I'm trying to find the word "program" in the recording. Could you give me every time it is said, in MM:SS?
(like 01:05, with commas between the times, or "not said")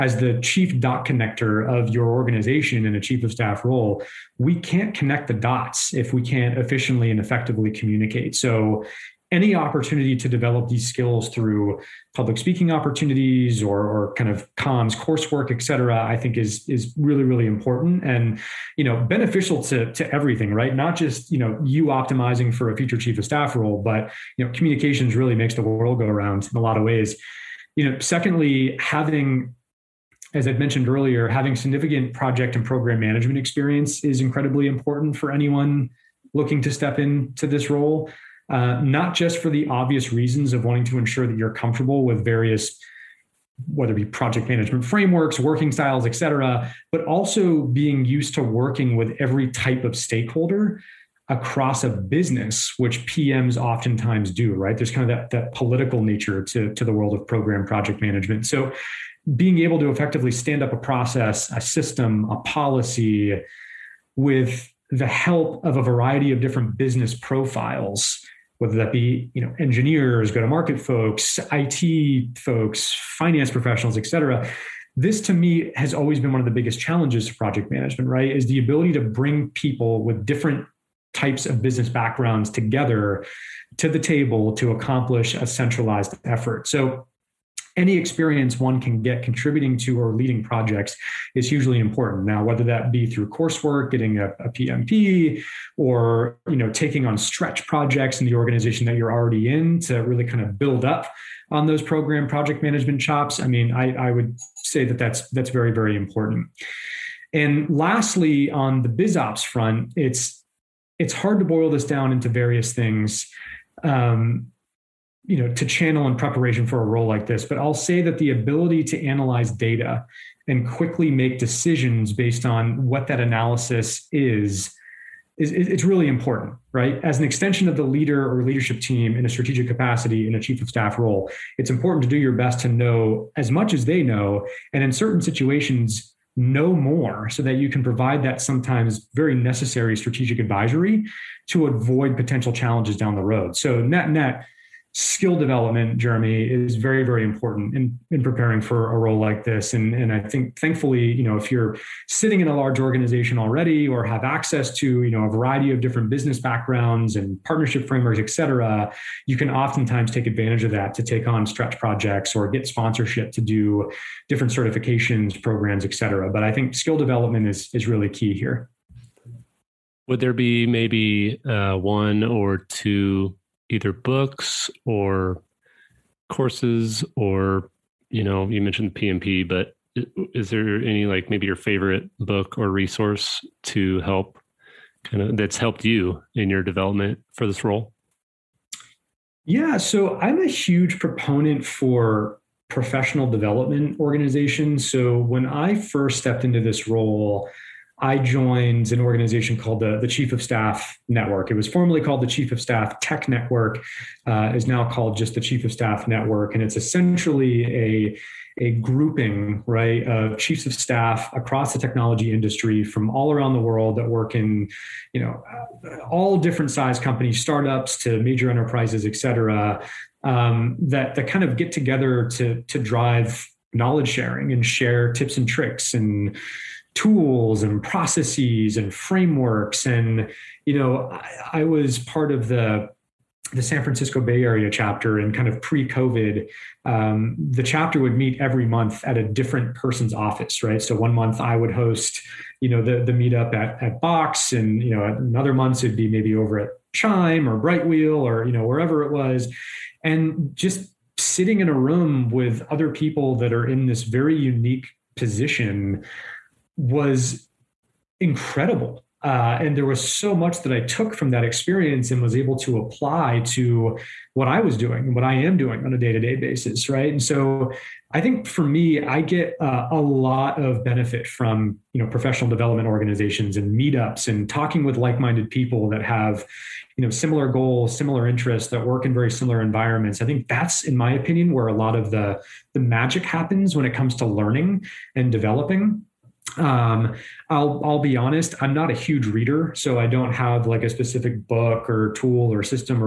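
00:32, 00:57, 01:41, 02:45.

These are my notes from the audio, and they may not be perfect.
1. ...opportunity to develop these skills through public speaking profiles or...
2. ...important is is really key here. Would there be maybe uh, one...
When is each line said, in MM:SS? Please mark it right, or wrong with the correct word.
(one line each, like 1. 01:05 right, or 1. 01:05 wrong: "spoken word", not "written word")
1. 00:09 wrong: "opportunities", not "profiles"
2. 02:46 wrong: "development", not "important".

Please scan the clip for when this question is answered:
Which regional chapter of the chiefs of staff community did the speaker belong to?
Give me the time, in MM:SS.
03:53.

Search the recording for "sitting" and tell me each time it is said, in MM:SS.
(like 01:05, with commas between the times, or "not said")
02:32, 04:11.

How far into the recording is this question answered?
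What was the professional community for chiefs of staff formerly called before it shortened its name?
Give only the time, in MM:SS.
03:22.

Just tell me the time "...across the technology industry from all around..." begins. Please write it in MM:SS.
03:31.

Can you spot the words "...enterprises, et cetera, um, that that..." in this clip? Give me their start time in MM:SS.
03:38.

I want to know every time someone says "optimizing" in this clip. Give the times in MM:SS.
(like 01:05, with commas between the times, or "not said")
00:21.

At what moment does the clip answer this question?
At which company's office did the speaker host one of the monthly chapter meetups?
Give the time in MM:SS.
04:04.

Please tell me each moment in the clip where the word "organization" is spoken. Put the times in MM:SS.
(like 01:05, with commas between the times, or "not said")
00:02, 01:38, 02:32, 03:13, 03:18, 04:32.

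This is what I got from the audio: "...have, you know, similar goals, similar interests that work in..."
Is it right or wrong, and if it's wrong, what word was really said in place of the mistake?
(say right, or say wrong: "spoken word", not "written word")
right.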